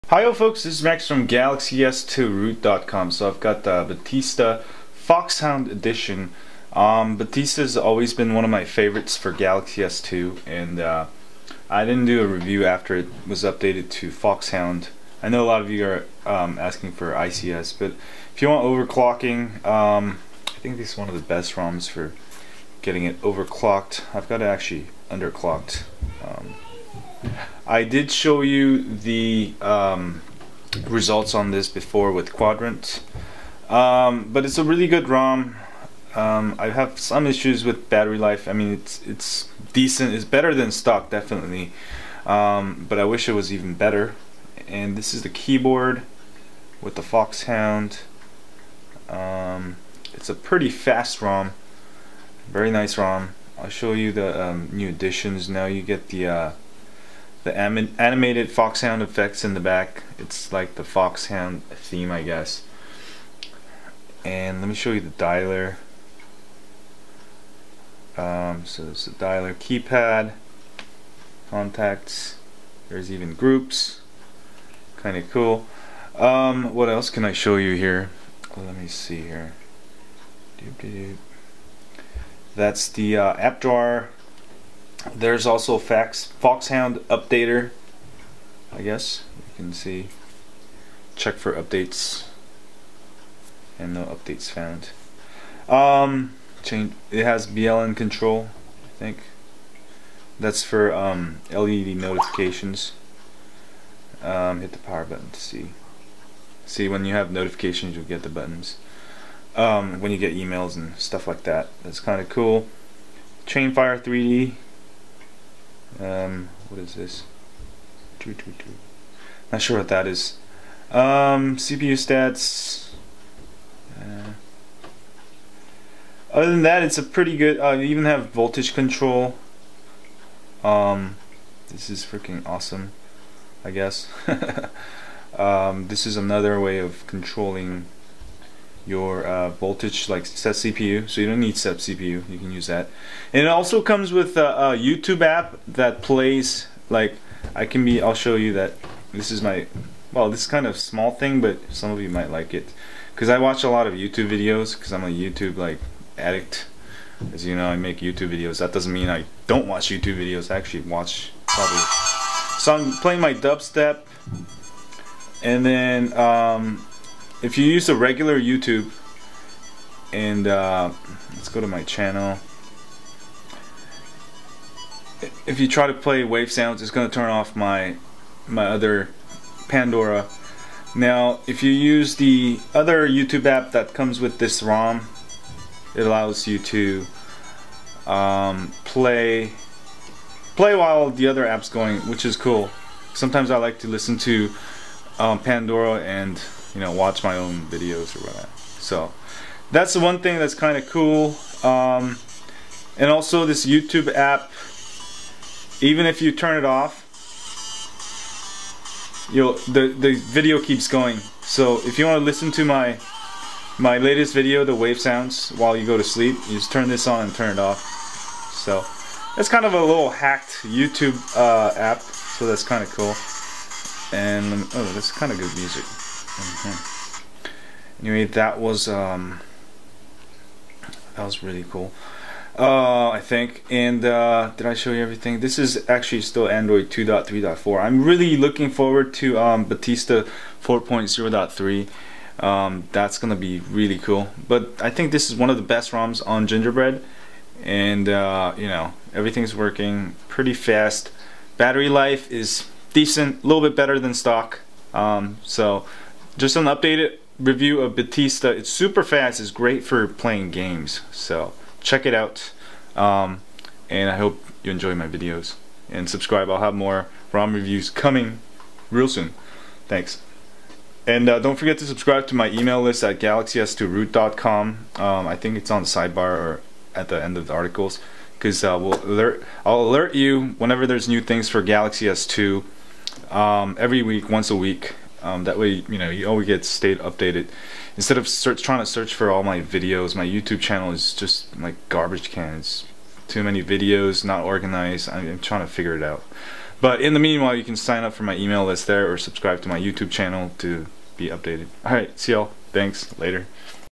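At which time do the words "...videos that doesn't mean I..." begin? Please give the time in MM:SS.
02:38.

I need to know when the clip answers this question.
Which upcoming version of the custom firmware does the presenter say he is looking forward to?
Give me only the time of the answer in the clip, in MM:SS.
03:59.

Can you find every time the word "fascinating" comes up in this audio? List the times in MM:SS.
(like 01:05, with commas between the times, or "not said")
not said.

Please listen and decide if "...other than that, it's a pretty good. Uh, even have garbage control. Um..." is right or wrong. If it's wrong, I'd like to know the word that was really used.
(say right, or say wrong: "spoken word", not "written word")
wrong: "voltage", not "garbage".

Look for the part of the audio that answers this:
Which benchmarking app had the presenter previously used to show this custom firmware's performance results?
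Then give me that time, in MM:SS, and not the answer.
00:32.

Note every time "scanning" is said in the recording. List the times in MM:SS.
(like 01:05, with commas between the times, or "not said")
not said.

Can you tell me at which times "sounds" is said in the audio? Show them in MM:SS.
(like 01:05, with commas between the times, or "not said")
02:56, 03:34.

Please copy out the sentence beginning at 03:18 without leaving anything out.
So that's the one thing that's kind of cool.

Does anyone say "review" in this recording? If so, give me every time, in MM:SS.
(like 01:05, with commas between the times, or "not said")
00:12, 04:17, 04:27.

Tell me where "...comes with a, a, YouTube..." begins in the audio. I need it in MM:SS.
02:23.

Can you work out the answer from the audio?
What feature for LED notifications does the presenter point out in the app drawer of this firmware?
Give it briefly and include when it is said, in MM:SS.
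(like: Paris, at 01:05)
BLN control, at 01:37.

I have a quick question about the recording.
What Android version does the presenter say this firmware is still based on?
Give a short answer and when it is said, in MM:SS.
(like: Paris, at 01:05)
2.3.4, at 03:56.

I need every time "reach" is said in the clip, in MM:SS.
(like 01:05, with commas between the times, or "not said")
not said.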